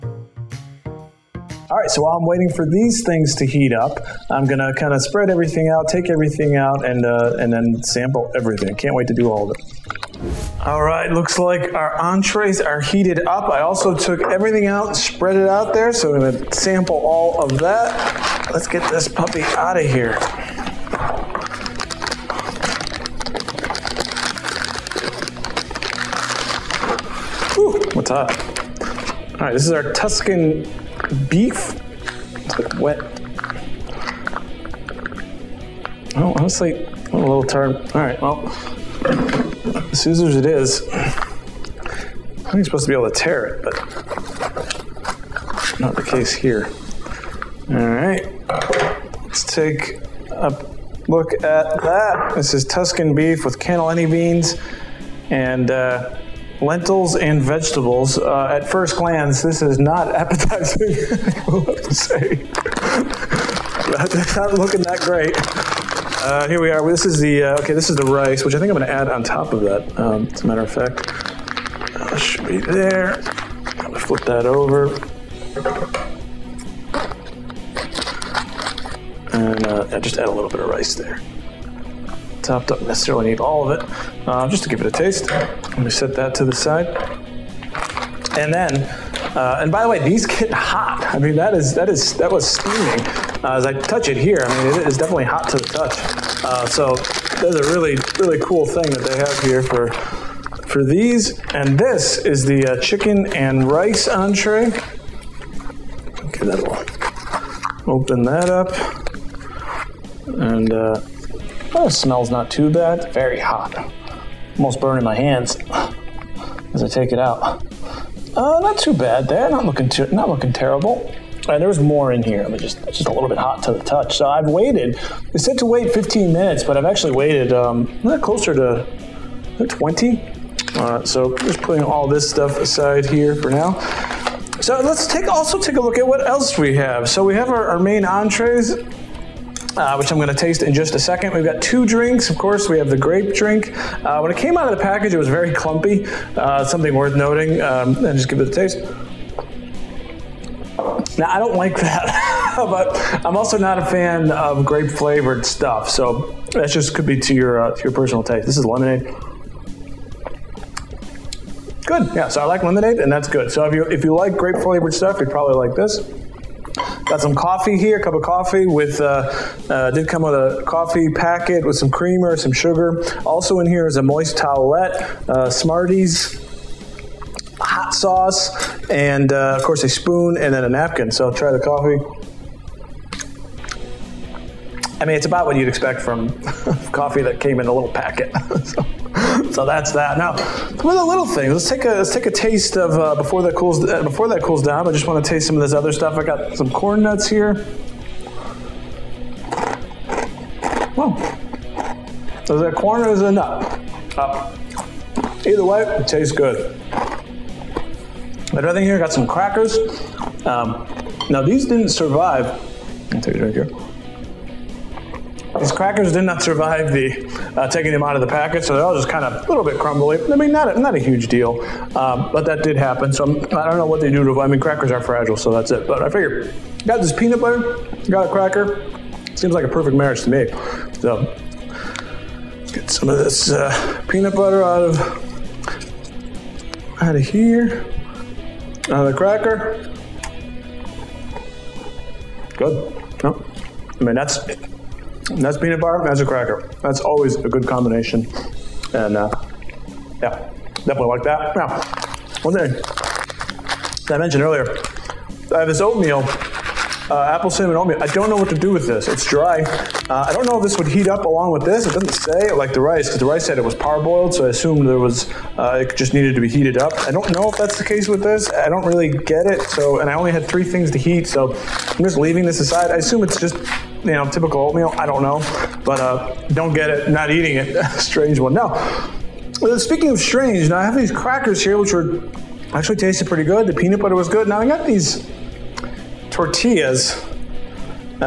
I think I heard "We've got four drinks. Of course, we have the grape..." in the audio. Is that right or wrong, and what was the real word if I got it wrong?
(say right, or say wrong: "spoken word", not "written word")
wrong: "two", not "four".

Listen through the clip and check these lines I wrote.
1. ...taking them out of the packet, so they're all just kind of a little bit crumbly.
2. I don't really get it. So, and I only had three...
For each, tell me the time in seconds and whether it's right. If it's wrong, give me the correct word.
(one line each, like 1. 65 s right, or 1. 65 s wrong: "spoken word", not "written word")
1. 217 s right
2. 268 s right.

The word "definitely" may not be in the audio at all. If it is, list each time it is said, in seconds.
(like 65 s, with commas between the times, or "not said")
94 s, 250 s.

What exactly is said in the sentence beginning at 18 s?
Let's get this puppy out of here.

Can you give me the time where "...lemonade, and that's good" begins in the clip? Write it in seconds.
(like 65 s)
162 s.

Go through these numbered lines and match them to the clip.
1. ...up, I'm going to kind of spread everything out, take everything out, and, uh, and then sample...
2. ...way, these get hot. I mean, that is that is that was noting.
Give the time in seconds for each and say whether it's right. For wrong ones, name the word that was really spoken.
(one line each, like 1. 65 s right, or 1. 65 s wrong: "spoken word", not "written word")
1. 3 s right
2. 89 s wrong: "steaming", not "noting".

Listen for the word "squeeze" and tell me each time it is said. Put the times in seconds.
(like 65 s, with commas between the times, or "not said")
not said.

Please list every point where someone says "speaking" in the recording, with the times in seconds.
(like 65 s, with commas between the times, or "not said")
279 s.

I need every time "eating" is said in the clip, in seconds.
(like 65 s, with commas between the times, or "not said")
277 s.